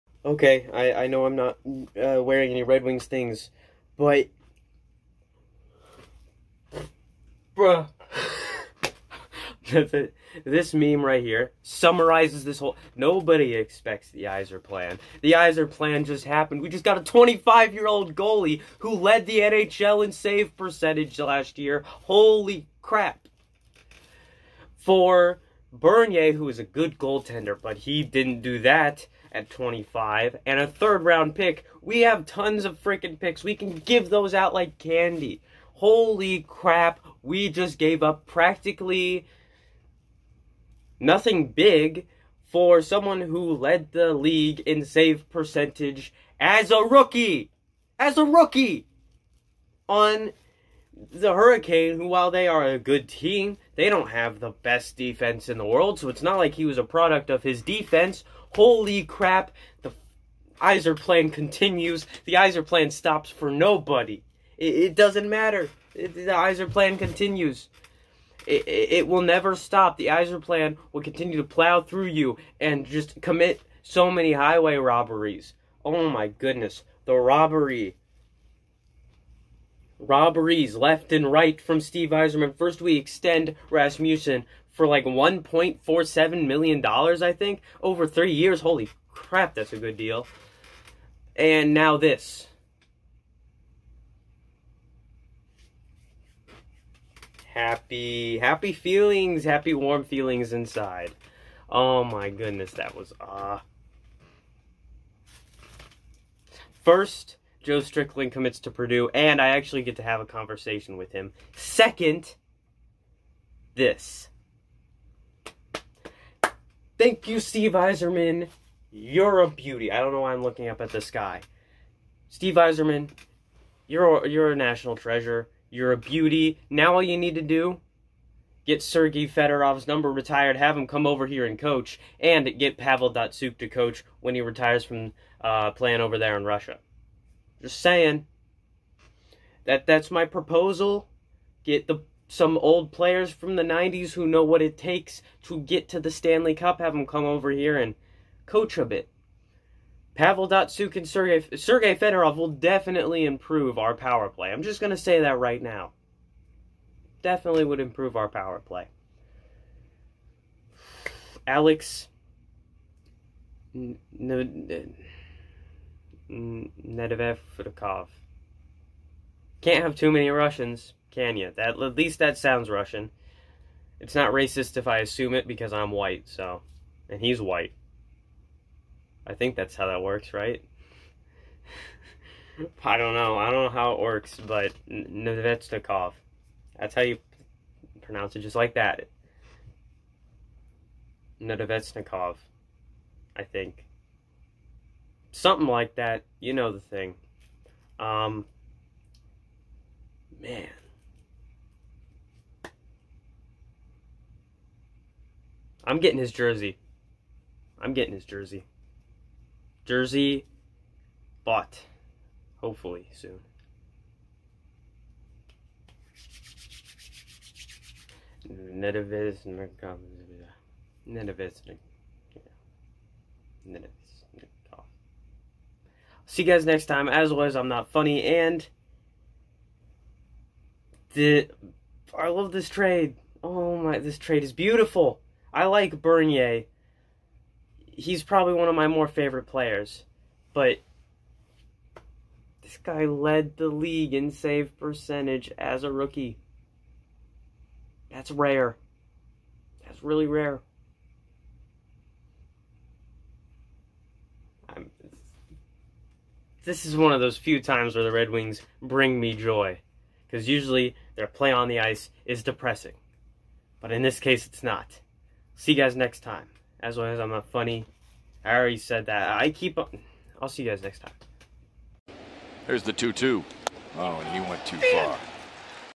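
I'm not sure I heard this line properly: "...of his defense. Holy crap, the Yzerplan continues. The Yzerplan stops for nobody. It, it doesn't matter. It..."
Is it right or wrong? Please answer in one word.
right.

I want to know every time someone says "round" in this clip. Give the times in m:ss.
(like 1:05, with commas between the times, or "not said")
0:31.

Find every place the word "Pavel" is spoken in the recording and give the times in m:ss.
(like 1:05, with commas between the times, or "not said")
2:12, 2:30.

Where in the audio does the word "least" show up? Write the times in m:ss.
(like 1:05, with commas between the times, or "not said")
2:51.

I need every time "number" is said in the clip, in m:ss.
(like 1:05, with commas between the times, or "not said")
2:09.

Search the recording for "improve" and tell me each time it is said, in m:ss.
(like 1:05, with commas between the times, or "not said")
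2:33, 2:37.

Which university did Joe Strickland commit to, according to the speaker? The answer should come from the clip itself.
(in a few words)
Purdue.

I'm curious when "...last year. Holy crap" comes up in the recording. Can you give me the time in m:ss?
0:21.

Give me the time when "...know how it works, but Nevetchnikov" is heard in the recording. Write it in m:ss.
3:03.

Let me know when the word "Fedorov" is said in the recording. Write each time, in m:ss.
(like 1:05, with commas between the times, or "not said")
2:09, 2:31.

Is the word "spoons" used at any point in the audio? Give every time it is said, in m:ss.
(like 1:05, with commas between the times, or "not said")
not said.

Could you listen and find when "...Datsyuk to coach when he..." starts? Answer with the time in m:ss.
2:13.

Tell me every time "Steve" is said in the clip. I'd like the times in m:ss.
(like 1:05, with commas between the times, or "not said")
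1:21, 1:57, 2:02.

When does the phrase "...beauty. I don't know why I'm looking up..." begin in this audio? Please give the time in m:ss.
1:59.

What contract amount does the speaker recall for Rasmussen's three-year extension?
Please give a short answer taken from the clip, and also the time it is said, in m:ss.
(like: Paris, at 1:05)
$1.47 million, at 1:25.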